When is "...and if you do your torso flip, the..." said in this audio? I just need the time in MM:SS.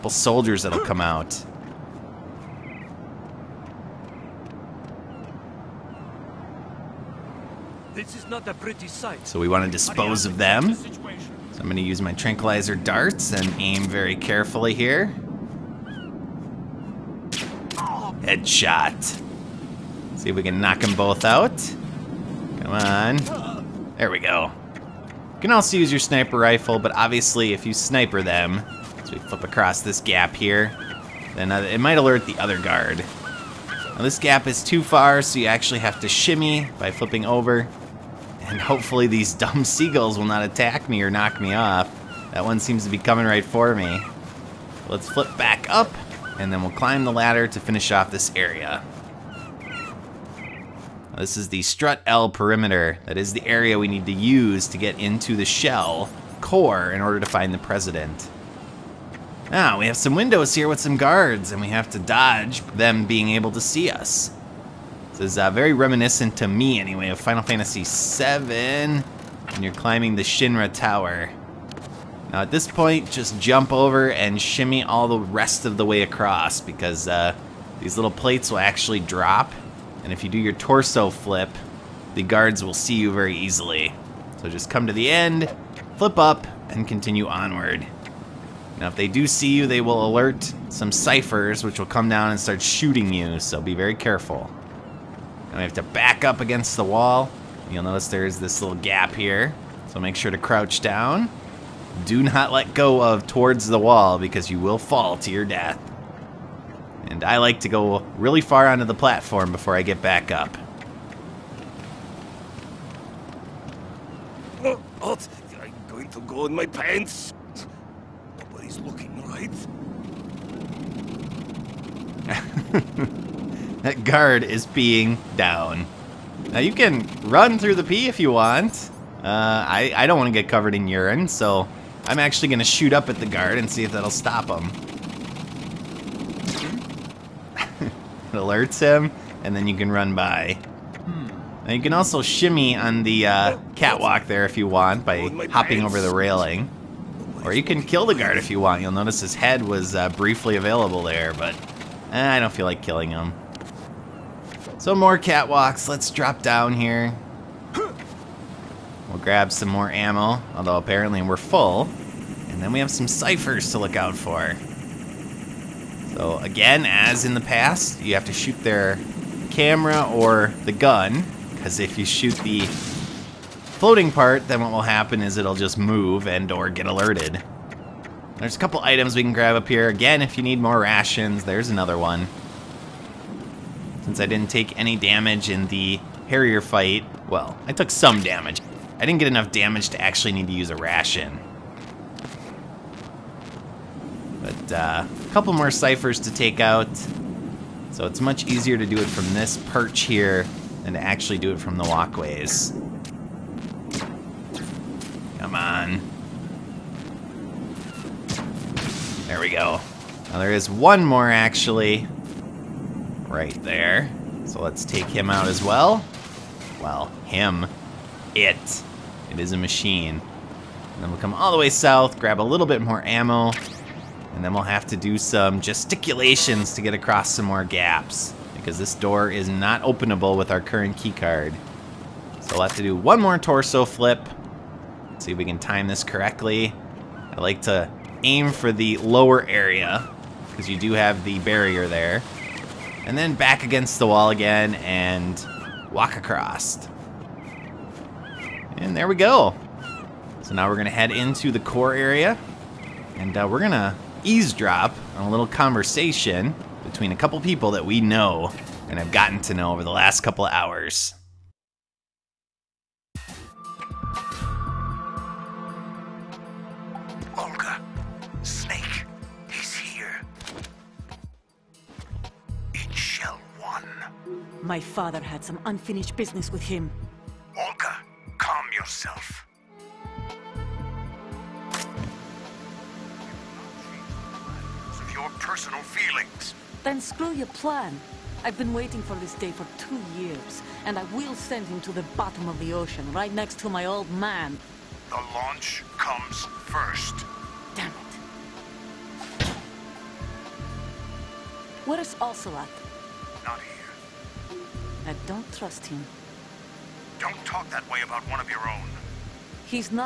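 01:20.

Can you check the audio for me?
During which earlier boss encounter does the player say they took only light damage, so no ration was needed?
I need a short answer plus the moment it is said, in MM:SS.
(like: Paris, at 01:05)
The Harrier fight, at 03:06.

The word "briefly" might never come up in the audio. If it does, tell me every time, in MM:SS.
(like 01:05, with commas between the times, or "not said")
02:30.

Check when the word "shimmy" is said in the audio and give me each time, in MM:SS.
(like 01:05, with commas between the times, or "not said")
00:36, 01:14, 02:22.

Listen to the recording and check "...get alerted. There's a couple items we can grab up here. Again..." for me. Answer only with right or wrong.
right.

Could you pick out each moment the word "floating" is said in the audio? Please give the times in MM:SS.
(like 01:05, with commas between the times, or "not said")
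02:52.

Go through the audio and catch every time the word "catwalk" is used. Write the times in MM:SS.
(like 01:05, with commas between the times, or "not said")
02:23, 02:35.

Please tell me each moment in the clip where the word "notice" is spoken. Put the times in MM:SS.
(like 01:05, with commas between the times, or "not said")
01:37, 02:28.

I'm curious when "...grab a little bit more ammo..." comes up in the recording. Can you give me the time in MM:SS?
03:42.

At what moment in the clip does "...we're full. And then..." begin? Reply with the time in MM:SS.
02:41.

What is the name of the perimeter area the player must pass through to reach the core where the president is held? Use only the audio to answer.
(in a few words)
Strut L perimeter.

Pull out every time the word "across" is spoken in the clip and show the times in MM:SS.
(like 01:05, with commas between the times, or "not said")
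00:29, 01:16, 03:46, 04:06.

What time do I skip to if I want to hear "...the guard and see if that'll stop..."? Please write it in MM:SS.
02:13.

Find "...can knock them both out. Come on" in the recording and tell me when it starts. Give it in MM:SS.
00:20.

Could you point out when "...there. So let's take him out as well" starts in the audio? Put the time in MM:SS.
03:33.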